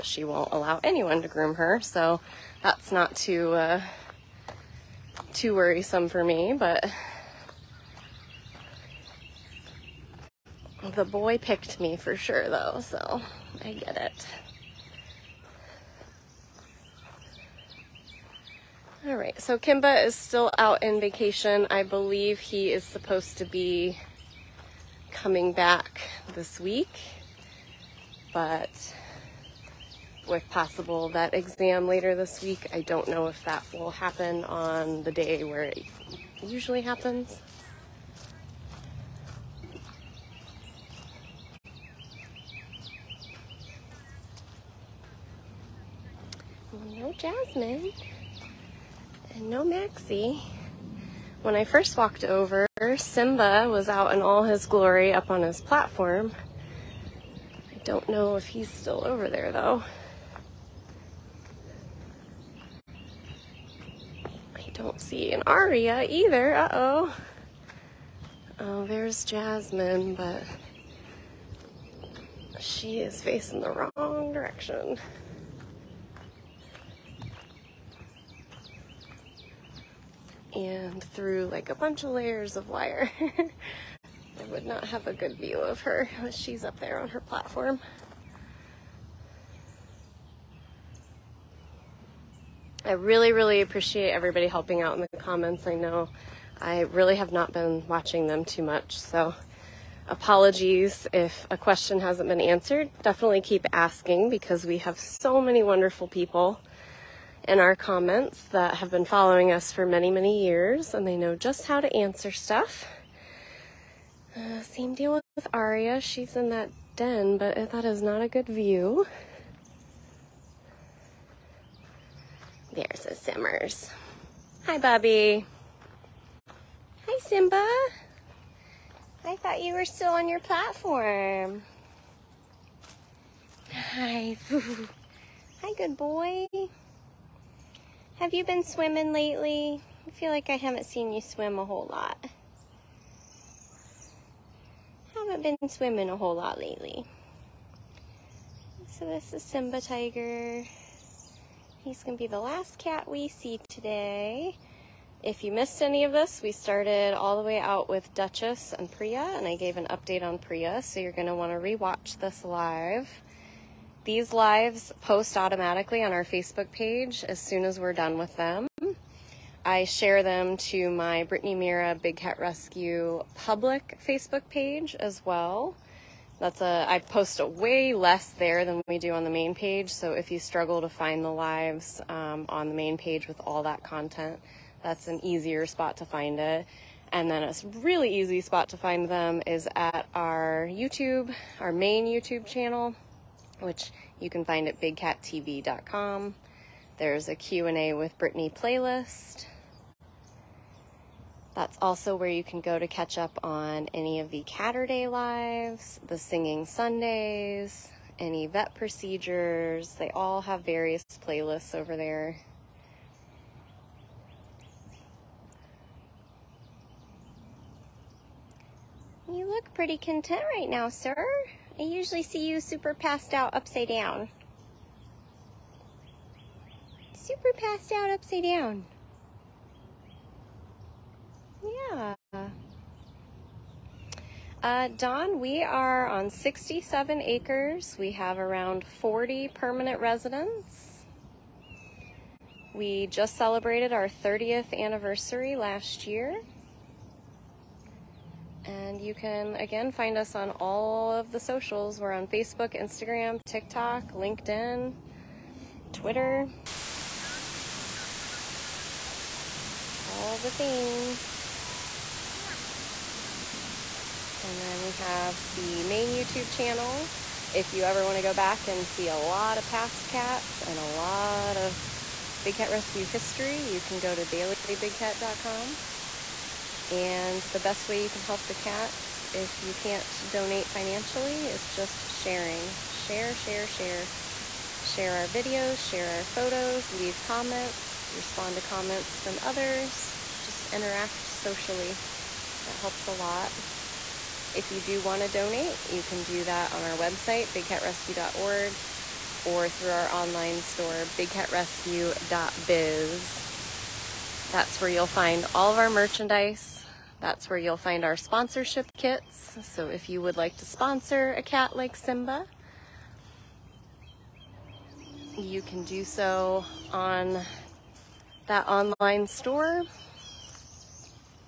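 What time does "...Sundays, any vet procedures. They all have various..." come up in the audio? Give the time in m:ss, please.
3:26.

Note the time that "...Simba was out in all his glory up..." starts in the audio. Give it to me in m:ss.
0:52.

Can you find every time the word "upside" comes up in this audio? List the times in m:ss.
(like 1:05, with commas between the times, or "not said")
3:43, 3:48.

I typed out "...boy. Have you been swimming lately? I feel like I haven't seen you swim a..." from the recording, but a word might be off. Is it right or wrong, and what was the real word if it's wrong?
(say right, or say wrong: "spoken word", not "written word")
right.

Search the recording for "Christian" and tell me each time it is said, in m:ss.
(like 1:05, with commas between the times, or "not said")
not said.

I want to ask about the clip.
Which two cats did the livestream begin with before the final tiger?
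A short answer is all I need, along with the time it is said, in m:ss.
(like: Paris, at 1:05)
Dutchess and Priya, at 2:38.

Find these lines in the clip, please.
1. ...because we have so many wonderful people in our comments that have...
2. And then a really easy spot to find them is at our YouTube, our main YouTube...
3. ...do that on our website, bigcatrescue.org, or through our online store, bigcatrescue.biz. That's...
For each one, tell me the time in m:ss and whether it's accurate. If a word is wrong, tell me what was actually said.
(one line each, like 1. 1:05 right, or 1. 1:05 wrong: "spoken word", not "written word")
1. 1:44 right
2. 3:07 right
3. 4:56 right.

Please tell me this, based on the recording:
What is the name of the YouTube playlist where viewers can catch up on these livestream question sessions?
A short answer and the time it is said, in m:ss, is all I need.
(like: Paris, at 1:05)
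Q&A with Brittany, at 3:17.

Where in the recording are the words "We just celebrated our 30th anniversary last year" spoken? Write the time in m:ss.
4:02.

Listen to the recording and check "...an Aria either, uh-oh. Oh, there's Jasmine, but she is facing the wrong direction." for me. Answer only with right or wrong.
right.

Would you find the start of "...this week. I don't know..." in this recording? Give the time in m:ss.
0:32.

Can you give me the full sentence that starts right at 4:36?
And the best way you can help the cats, if you can't donate financially, is just sharing.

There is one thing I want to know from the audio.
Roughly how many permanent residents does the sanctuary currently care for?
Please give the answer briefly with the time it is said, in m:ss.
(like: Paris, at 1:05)
40, at 3:58.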